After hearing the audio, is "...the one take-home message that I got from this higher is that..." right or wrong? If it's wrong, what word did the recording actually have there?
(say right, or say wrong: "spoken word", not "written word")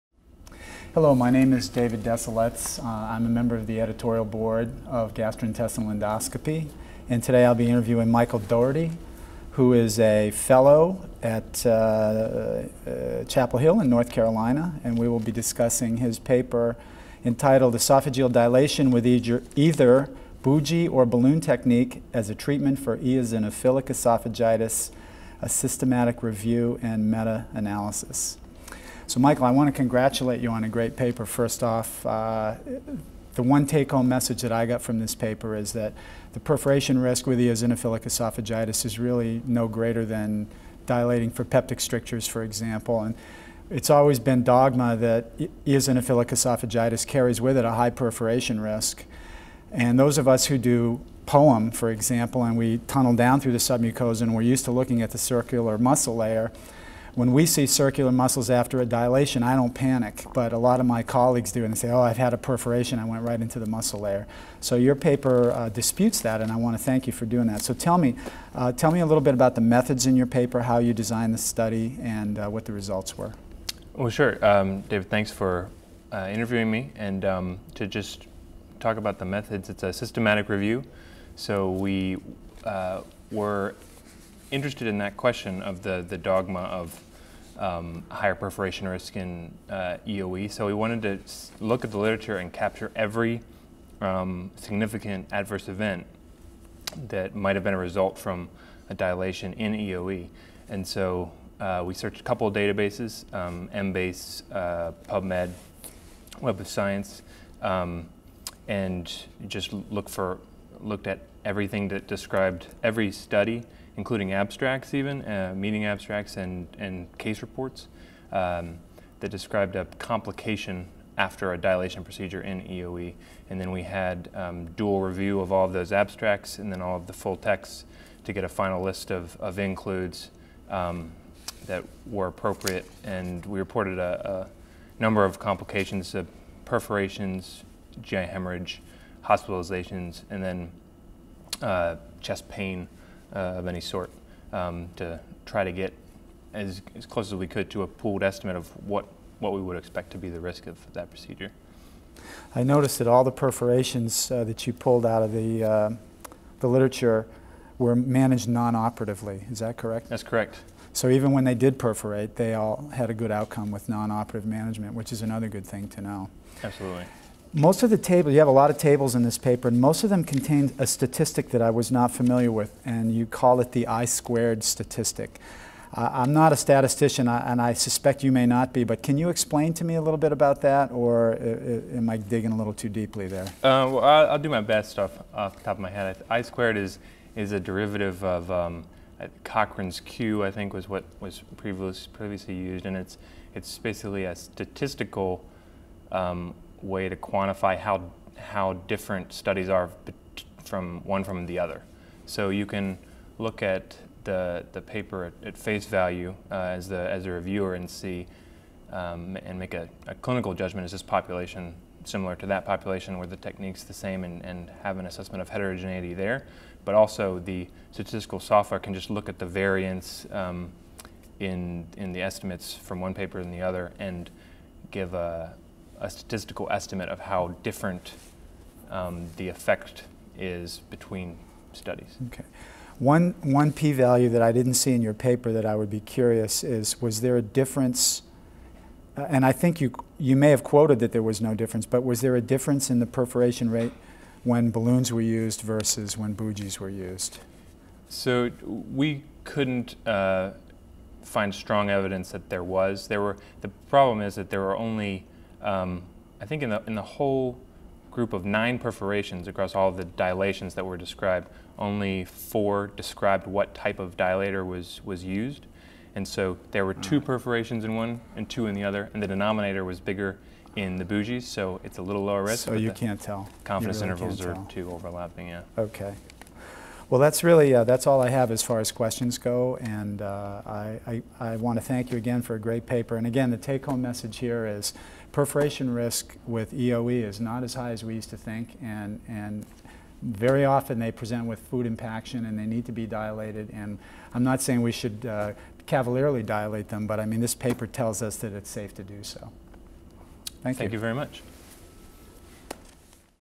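wrong: "paper", not "higher".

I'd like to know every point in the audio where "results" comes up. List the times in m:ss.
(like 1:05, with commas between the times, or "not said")
1:12, 1:37.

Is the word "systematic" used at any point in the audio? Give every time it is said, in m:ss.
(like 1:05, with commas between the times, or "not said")
0:25, 1:19.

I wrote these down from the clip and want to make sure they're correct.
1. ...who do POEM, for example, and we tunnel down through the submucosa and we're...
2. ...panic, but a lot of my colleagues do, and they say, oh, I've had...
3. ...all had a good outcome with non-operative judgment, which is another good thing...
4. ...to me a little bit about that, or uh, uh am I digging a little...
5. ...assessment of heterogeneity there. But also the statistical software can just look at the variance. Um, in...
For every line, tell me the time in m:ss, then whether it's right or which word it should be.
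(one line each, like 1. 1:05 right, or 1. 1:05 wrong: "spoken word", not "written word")
1. 0:50 right
2. 0:59 right
3. 2:42 wrong: "management", not "judgment"
4. 2:59 right
5. 3:35 right.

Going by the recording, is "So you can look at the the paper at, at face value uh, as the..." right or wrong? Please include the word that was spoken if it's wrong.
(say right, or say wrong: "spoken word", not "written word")
right.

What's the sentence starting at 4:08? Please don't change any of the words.
So we couldn't uh, find strong evidence that there was.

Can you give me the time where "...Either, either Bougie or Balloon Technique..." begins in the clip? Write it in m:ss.
0:19.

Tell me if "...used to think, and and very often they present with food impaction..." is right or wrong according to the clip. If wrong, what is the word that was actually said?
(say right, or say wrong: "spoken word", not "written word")
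right.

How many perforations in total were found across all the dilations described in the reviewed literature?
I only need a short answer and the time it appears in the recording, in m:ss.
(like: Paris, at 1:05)
9, at 4:18.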